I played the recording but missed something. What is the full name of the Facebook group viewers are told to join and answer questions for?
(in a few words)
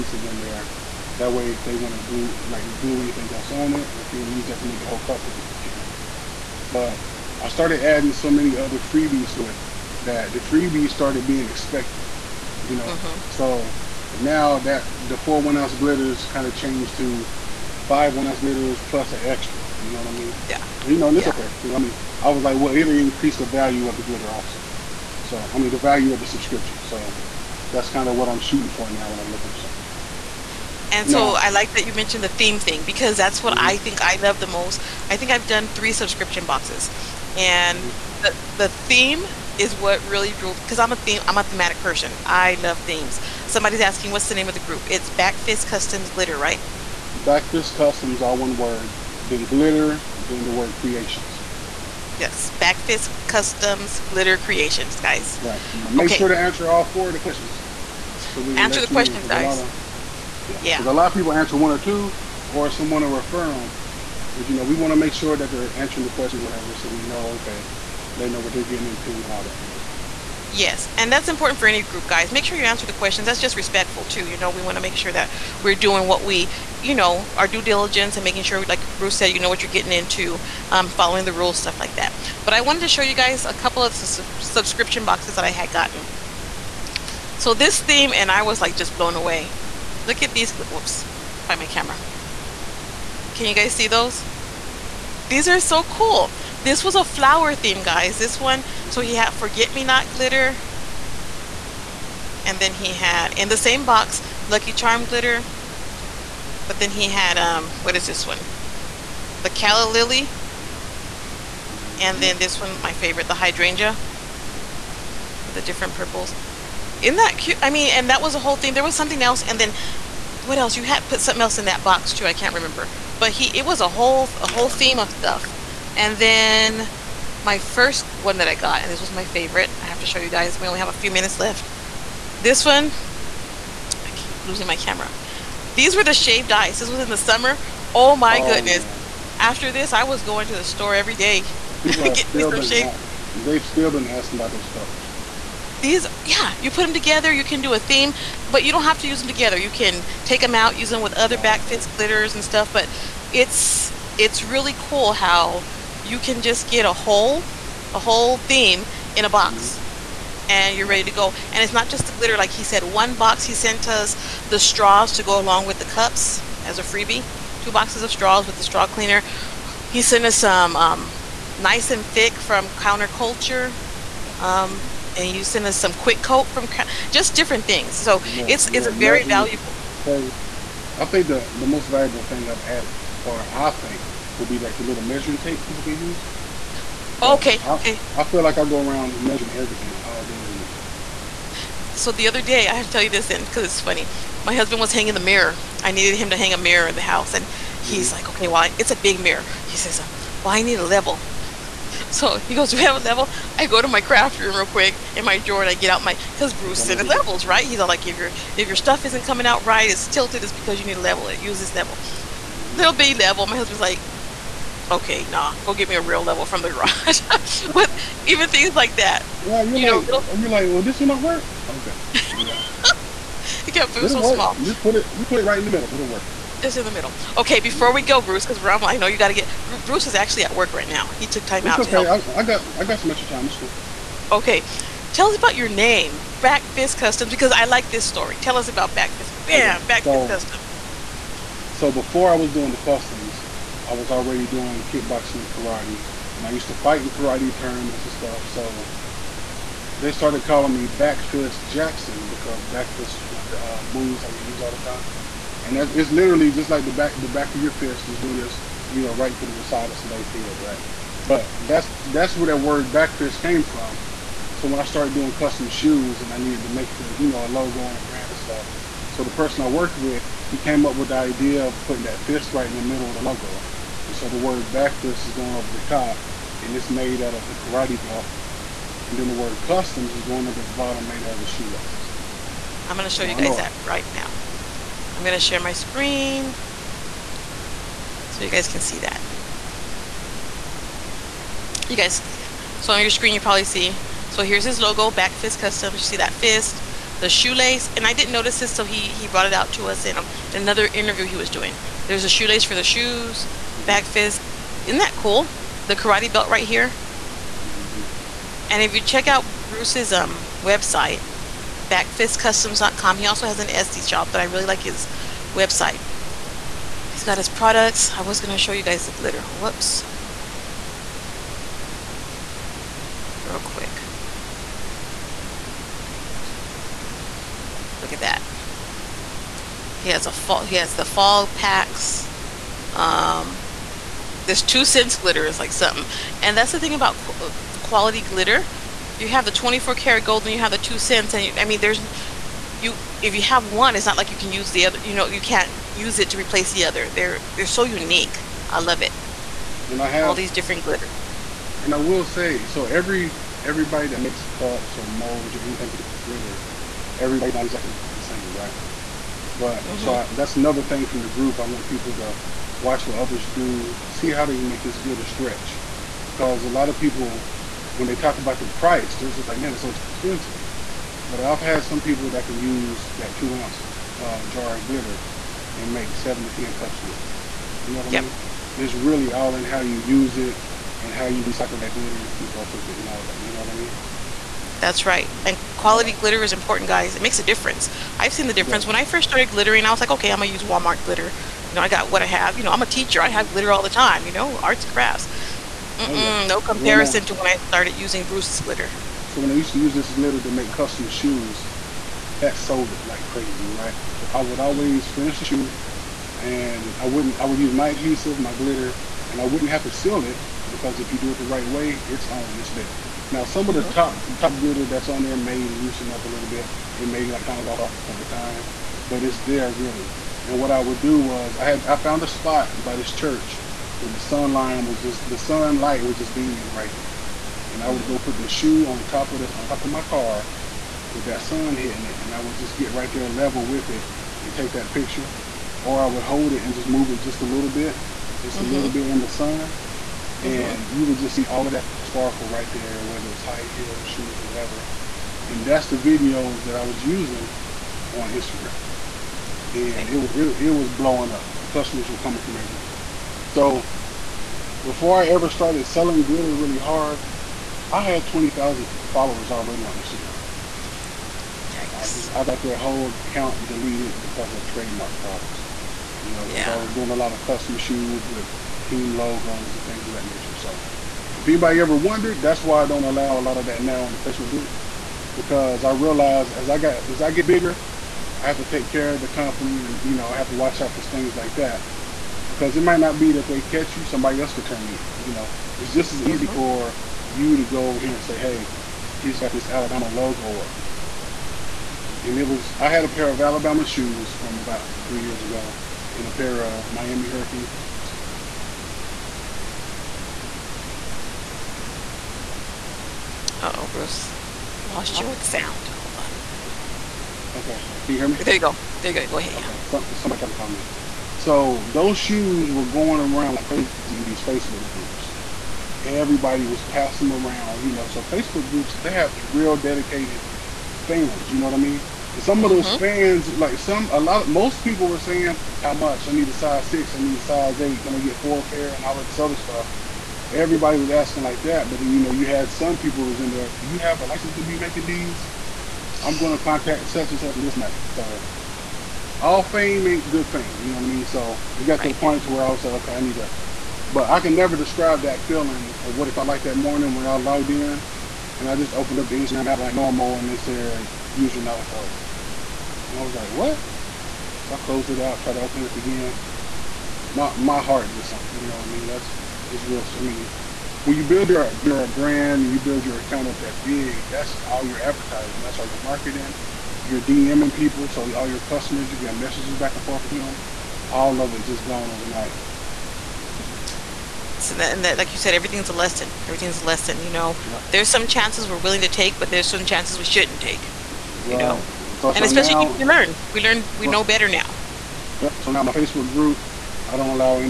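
Backfist Customs Glitter Creations.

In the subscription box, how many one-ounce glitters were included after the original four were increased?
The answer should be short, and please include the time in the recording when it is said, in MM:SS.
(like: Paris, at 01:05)
5, at 00:17.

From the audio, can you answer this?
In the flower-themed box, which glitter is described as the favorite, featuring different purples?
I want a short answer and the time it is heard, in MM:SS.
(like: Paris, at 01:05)
Hydrangea, at 01:53.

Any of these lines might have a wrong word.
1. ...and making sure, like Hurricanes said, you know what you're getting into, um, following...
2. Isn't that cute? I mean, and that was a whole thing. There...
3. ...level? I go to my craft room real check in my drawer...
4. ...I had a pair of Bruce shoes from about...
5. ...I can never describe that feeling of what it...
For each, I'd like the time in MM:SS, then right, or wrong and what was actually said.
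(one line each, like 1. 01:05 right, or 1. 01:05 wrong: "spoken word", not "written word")
1. 01:18 wrong: "Bruce", not "Hurricanes"
2. 01:57 right
3. 03:22 wrong: "quick", not "check"
4. 08:12 wrong: "Alabama", not "Bruce"
5. 09:04 right.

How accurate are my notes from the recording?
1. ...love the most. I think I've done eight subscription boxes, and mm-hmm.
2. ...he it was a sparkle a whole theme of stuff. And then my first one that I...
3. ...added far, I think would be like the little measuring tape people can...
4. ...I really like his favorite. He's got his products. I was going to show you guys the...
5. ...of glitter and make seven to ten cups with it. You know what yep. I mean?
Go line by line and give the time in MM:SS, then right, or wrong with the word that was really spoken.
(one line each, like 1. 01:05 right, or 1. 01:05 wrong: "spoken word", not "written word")
1. 00:34 wrong: "three", not "eight"
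2. 02:03 wrong: "whole", not "sparkle"
3. 03:02 right
4. 05:14 wrong: "website", not "favorite"
5. 06:14 right.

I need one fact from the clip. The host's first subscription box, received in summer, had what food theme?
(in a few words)
Shaved ice.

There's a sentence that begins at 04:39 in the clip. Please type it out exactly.
And then the word customs is going under the bottom made out of the shoelaces.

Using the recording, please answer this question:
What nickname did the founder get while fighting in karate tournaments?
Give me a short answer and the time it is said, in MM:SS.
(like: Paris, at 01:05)
Back Fist Jackson, at 04:10.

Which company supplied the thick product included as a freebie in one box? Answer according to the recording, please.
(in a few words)
Counter Culture.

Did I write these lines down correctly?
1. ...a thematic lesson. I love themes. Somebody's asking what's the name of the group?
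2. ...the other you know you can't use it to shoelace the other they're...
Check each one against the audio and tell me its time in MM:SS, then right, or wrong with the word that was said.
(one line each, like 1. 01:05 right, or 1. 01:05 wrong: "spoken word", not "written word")
1. 00:41 wrong: "person", not "lesson"
2. 05:44 wrong: "replace", not "shoelace".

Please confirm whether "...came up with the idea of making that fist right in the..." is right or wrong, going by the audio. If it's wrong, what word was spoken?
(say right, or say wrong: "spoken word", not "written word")
wrong: "putting", not "making".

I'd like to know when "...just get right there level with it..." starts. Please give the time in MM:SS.
07:12.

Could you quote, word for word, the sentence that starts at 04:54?
So here's his logo, Back Fist Customs.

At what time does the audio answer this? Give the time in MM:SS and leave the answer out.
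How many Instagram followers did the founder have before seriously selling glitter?
07:38.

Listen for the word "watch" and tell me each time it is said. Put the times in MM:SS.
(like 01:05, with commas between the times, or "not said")
06:02, 08:00.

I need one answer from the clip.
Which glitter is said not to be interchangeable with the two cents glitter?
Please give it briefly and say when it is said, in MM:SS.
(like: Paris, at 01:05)
24 karat gold, at 05:39.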